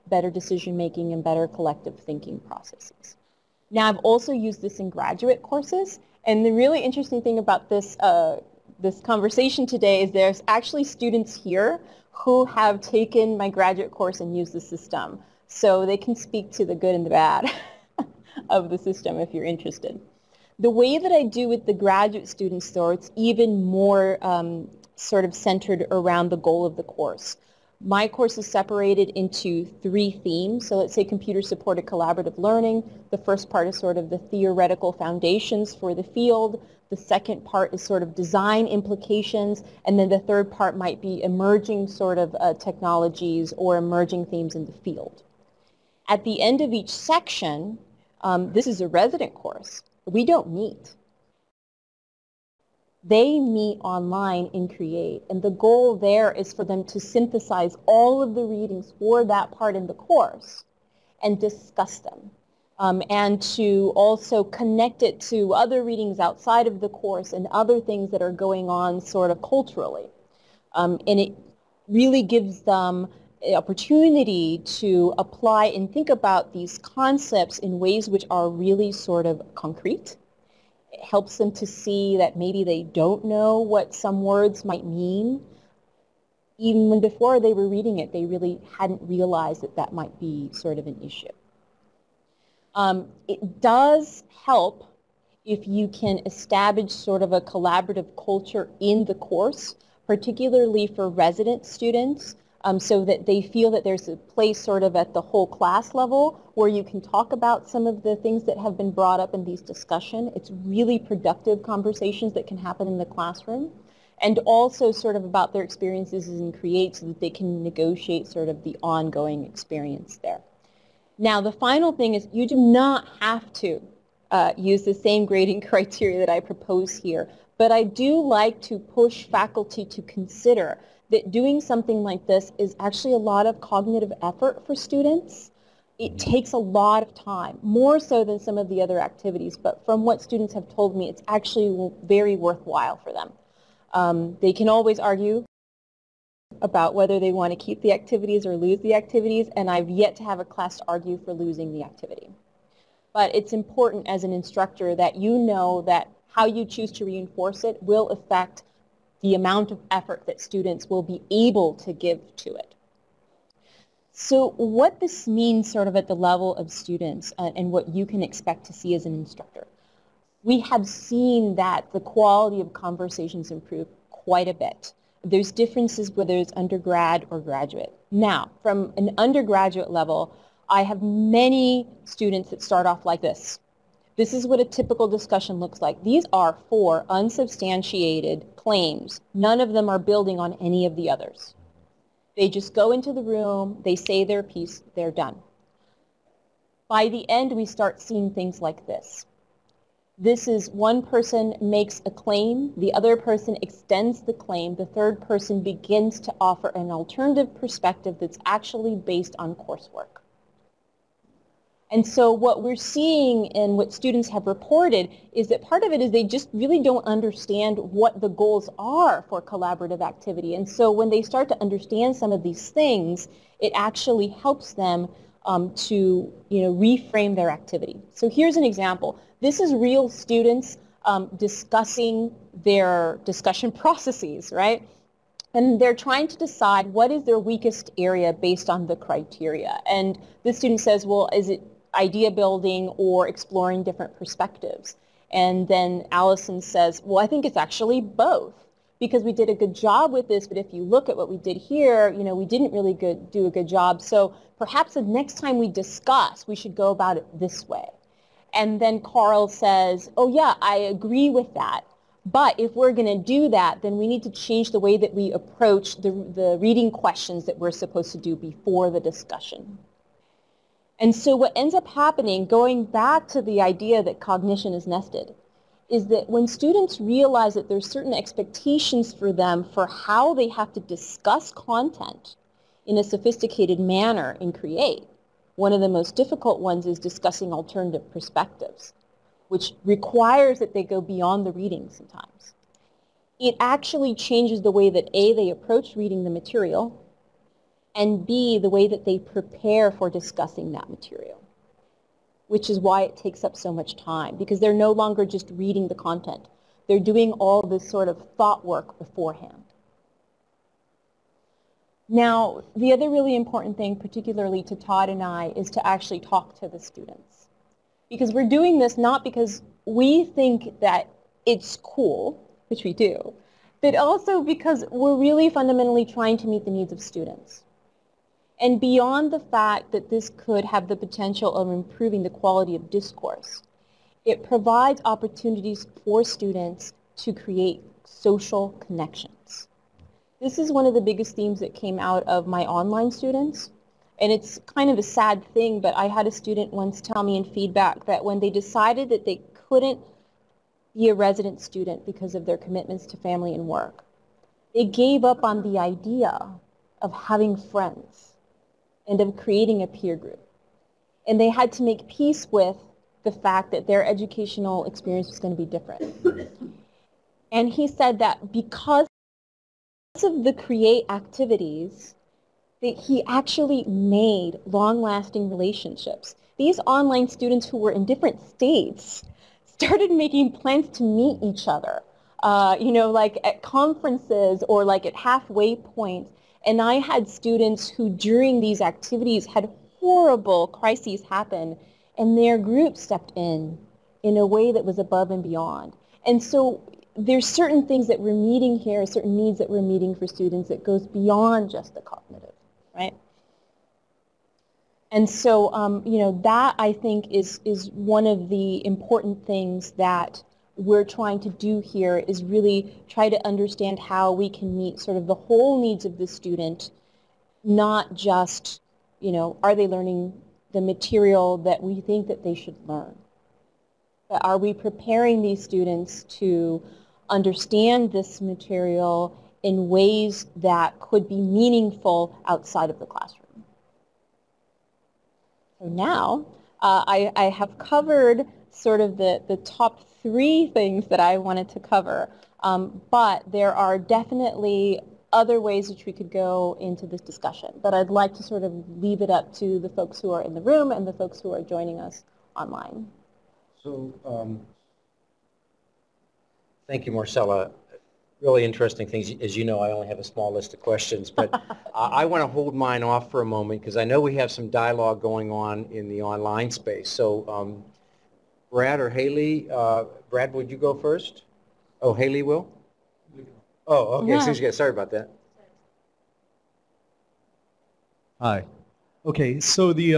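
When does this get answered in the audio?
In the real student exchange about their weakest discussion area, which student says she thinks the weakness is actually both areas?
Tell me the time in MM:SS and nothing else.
04:06.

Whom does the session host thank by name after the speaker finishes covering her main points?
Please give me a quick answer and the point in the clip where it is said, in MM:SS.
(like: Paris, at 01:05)
Marcela, at 07:37.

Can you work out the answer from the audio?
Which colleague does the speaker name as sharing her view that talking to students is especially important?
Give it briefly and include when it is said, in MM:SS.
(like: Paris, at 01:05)
Todd, at 05:14.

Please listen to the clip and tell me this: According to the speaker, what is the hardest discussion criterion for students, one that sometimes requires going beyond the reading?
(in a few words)
Discussing alternative perspectives.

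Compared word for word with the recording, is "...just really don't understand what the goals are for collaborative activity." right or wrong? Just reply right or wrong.
right.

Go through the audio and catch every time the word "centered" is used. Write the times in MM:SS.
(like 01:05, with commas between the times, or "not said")
00:25.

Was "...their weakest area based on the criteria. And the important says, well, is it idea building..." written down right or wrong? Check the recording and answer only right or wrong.
wrong.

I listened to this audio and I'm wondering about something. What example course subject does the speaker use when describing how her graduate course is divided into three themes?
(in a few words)
Computer-supported collaborative learning.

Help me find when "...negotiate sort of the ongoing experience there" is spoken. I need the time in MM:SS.
01:57.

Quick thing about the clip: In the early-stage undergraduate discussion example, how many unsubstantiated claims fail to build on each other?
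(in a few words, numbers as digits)
4.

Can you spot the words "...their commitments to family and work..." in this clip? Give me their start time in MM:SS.
05:52.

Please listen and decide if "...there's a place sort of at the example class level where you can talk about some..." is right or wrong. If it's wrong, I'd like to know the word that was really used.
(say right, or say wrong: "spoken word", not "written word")
wrong: "whole", not "example".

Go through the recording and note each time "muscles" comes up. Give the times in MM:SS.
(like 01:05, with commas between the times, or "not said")
not said.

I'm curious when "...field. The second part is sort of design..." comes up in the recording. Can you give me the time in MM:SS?
00:36.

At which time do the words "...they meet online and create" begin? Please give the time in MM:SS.
00:53.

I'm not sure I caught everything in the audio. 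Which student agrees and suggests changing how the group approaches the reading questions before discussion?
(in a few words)
Carl.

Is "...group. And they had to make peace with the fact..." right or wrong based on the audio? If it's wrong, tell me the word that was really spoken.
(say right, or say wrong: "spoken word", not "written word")
right.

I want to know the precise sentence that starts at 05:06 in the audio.
They're doing all this sort of thought work beforehand.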